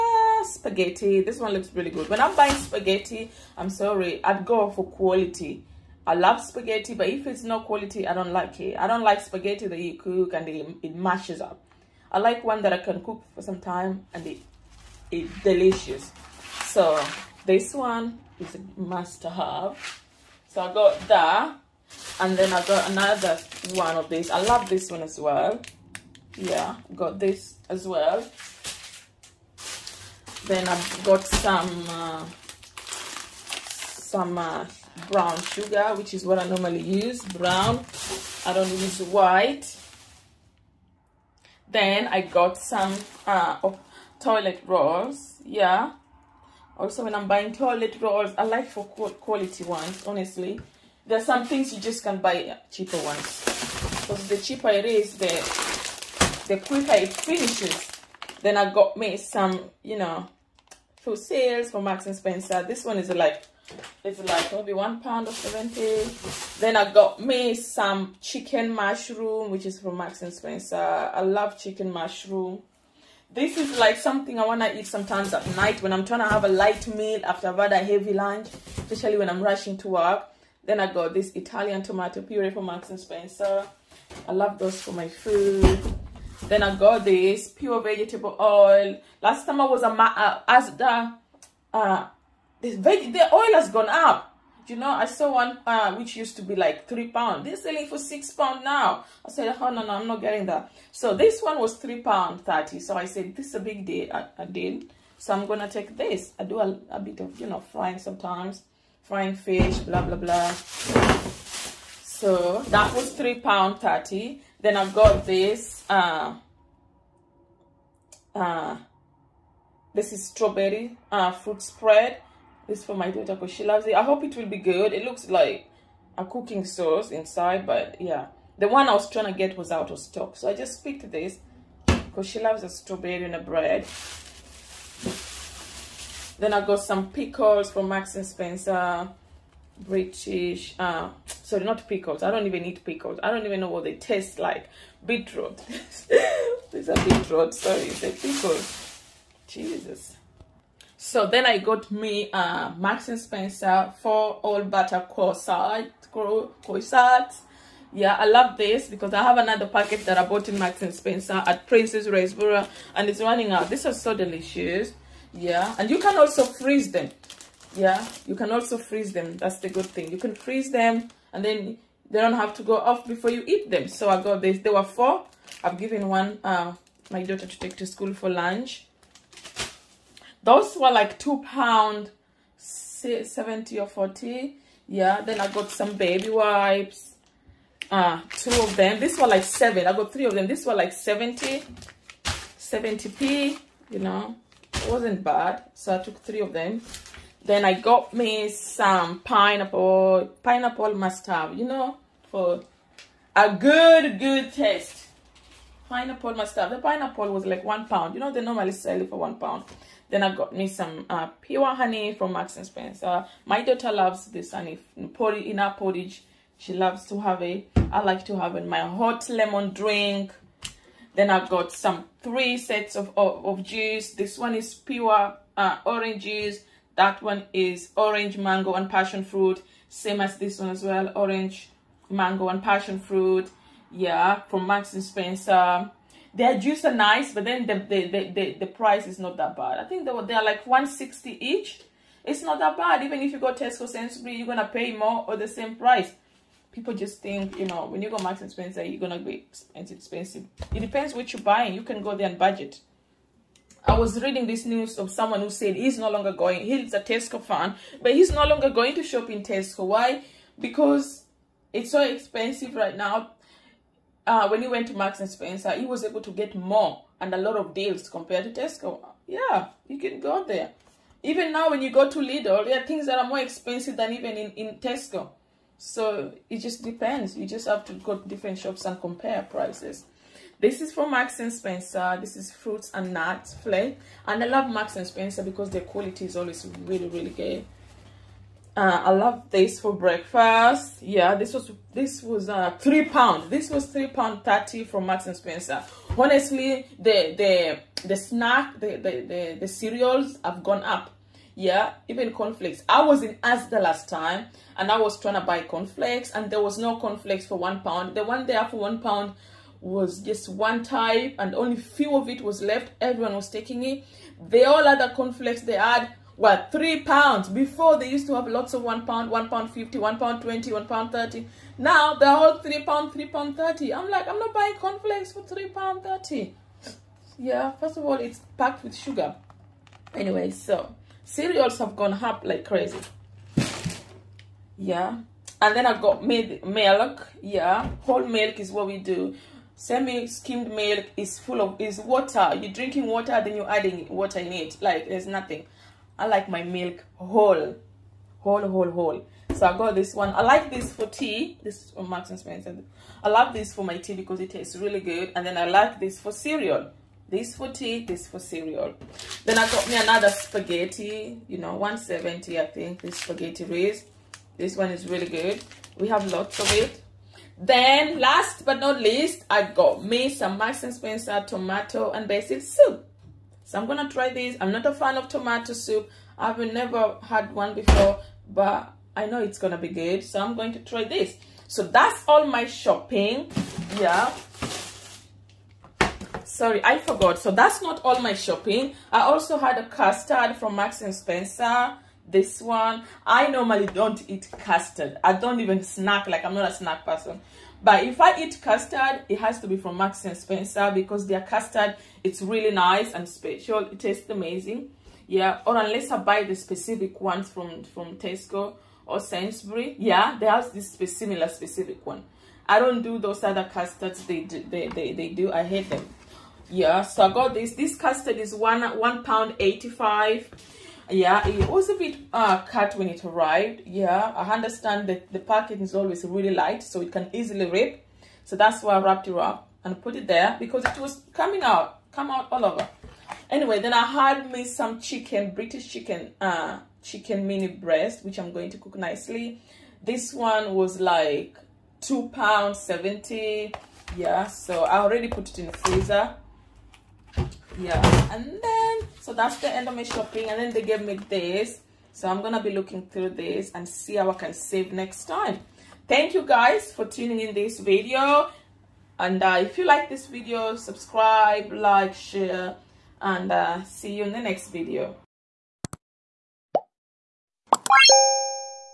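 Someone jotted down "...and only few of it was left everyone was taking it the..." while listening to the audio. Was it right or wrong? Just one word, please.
right.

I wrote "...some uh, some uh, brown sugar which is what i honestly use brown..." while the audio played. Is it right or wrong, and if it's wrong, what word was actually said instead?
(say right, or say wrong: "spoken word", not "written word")
wrong: "normally", not "honestly".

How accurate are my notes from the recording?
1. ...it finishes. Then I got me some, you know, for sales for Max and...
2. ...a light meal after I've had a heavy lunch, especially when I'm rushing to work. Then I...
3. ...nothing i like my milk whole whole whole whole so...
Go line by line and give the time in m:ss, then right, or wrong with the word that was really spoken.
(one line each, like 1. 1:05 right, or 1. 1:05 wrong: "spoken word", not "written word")
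1. 0:56 right
2. 1:16 right
3. 5:45 right.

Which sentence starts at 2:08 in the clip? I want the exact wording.
The one I was trying to get was out of stock.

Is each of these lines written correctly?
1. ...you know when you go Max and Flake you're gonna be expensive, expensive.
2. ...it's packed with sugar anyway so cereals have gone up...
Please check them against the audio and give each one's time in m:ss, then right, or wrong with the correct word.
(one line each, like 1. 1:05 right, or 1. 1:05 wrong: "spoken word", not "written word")
1. 4:07 wrong: "Spencer", not "Flake"
2. 5:28 right.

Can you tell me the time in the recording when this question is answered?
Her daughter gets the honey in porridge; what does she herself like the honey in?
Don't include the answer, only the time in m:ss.
3:38.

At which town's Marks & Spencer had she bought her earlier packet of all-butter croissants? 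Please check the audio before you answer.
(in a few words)
Princes Risborough.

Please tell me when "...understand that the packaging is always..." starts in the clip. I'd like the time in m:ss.
7:04.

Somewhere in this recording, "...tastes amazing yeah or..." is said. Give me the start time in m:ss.
6:43.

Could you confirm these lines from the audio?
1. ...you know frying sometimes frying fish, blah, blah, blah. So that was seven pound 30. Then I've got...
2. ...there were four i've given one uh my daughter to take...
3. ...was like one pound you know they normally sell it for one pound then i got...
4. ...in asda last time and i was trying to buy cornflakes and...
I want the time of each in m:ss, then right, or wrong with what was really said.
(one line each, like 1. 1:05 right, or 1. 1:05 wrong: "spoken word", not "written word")
1. 1:47 wrong: "three", not "seven"
2. 2:54 right
3. 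3:27 right
4. 5:03 right.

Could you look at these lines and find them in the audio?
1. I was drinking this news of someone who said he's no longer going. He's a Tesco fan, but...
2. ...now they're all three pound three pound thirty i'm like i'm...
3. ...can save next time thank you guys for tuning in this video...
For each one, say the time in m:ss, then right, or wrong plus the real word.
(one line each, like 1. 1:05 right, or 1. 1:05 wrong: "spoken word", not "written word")
1. 4:13 wrong: "reading", not "drinking"
2. 5:21 right
3. 7:34 right.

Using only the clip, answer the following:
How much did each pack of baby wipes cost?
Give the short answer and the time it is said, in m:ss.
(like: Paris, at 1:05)
70p, at 3:12.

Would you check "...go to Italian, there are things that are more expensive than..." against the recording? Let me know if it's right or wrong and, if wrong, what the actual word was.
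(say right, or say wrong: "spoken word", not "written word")
wrong: "Lidl", not "Italian".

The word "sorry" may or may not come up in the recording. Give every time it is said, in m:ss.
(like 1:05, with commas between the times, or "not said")
0:03, 2:21, 2:27, 6:26.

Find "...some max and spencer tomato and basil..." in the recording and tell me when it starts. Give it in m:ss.
6:10.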